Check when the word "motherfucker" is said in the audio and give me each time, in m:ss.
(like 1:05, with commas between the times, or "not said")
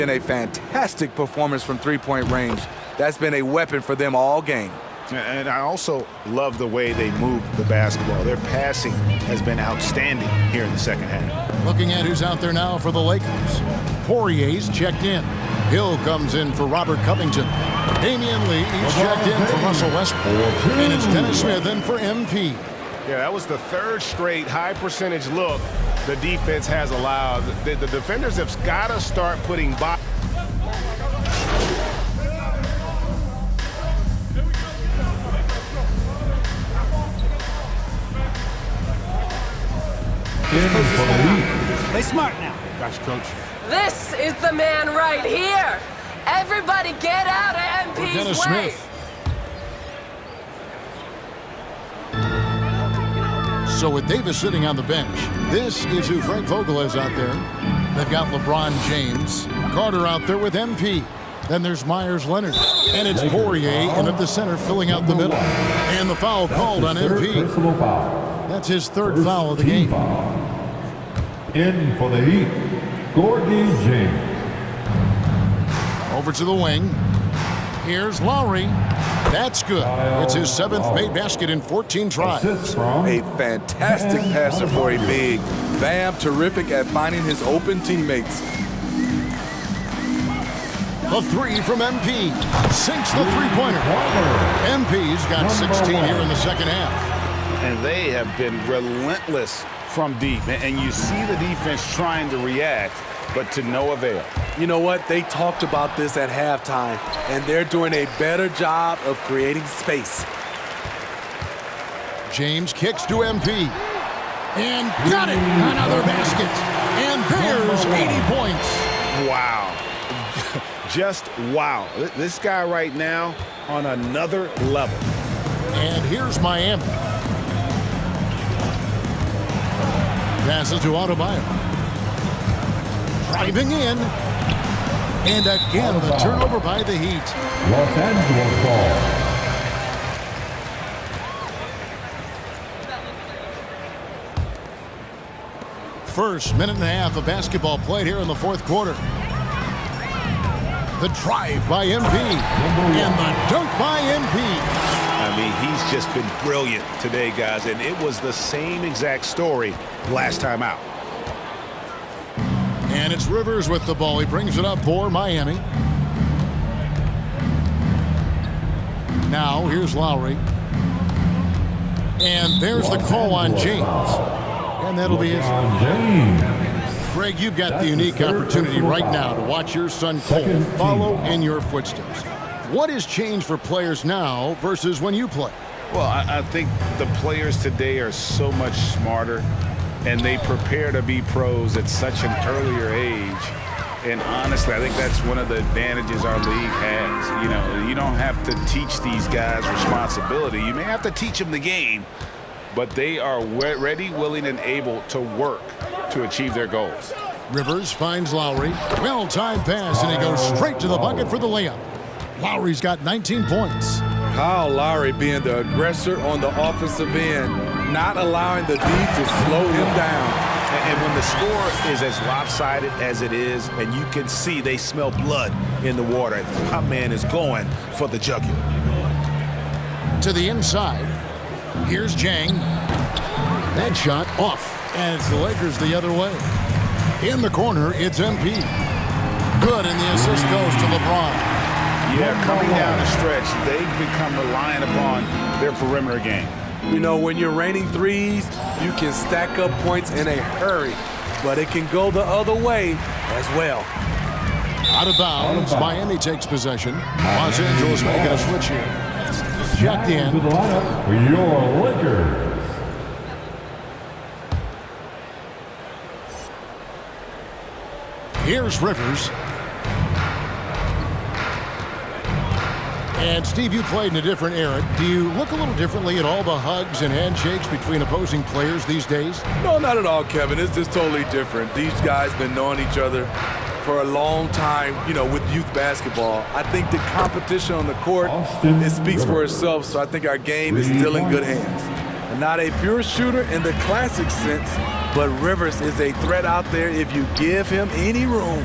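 not said.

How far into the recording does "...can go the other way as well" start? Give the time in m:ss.
4:11.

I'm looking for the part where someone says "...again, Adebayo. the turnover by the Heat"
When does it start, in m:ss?
2:15.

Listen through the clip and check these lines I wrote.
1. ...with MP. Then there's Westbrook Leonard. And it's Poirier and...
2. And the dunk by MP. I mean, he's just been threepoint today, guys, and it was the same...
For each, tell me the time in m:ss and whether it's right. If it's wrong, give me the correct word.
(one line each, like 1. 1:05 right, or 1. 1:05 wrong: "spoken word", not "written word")
1. 1:00 wrong: "Meyers", not "Westbrook"
2. 2:32 wrong: "brilliant", not "threepoint".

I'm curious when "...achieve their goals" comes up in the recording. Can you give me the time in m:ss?
3:26.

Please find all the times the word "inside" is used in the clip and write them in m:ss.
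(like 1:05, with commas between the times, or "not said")
3:50.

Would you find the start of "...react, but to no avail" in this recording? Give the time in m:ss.
1:42.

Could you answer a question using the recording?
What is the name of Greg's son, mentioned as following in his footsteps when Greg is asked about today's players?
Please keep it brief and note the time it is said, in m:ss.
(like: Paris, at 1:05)
Cole, at 3:00.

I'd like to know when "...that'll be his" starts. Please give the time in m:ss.
2:54.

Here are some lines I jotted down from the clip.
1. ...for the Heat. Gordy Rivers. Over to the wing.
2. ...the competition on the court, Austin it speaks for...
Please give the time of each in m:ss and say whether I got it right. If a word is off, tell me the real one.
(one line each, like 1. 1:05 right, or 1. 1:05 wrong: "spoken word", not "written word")
1. 1:11 wrong: "James", not "Rivers"
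2. 4:46 right.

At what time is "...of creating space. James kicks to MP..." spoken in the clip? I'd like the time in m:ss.
1:49.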